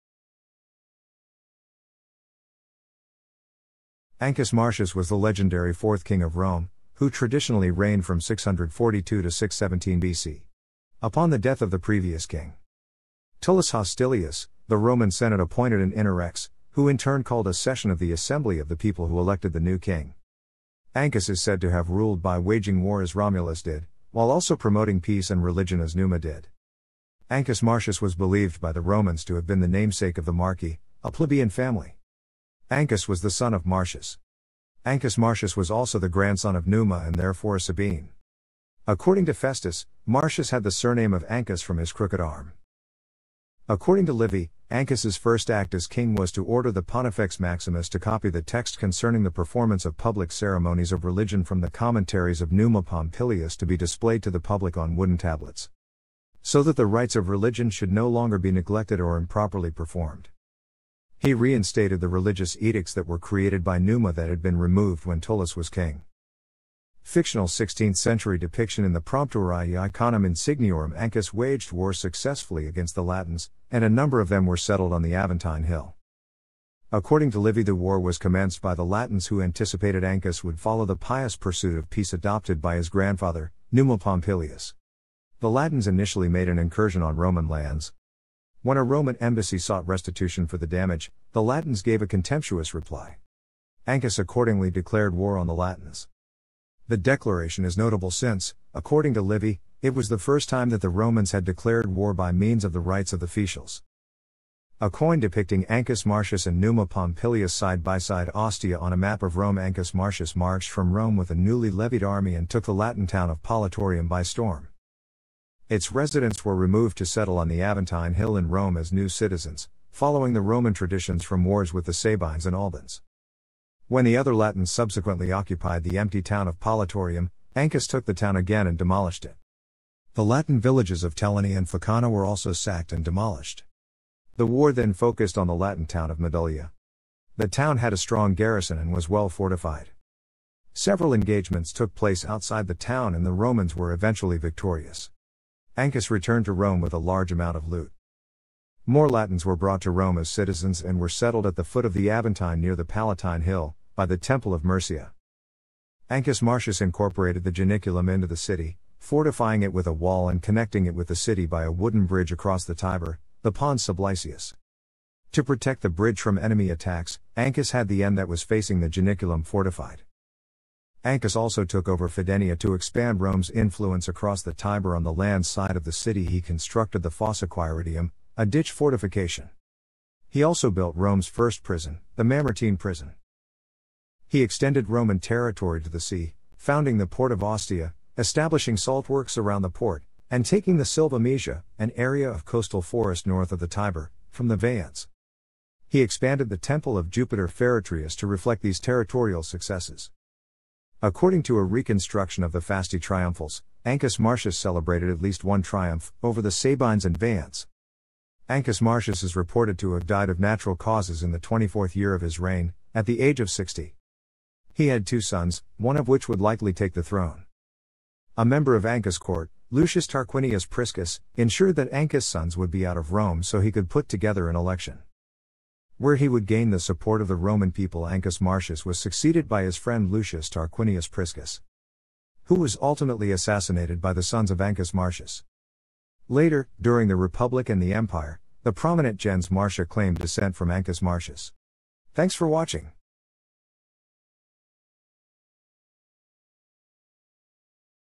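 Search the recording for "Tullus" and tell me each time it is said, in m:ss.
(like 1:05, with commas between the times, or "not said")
0:13, 1:05.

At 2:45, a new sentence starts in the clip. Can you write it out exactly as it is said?
To protect the bridge from enemy attacks, Ancus had the end that was facing the Janiculum fortified.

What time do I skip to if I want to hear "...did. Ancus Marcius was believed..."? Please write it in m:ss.
0:26.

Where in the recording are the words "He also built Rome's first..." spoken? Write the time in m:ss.
3:00.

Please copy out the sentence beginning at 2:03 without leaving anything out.
When the other Latins subsequently occupied the empty town of Politorium, Ancus took the town again and demolished it.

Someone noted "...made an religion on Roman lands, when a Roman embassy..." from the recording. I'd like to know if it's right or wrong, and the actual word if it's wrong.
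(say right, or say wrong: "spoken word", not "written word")
wrong: "incursion", not "religion".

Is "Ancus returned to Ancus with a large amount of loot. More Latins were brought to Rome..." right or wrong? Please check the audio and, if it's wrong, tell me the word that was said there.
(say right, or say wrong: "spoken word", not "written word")
wrong: "Rome", not "Ancus".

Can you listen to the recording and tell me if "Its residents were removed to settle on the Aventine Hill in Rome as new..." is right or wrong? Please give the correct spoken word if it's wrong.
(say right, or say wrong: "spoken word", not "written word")
right.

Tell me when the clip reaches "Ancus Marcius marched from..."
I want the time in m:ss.
1:49.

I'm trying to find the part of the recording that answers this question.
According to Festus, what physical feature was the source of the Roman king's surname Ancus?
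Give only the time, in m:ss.
0:41.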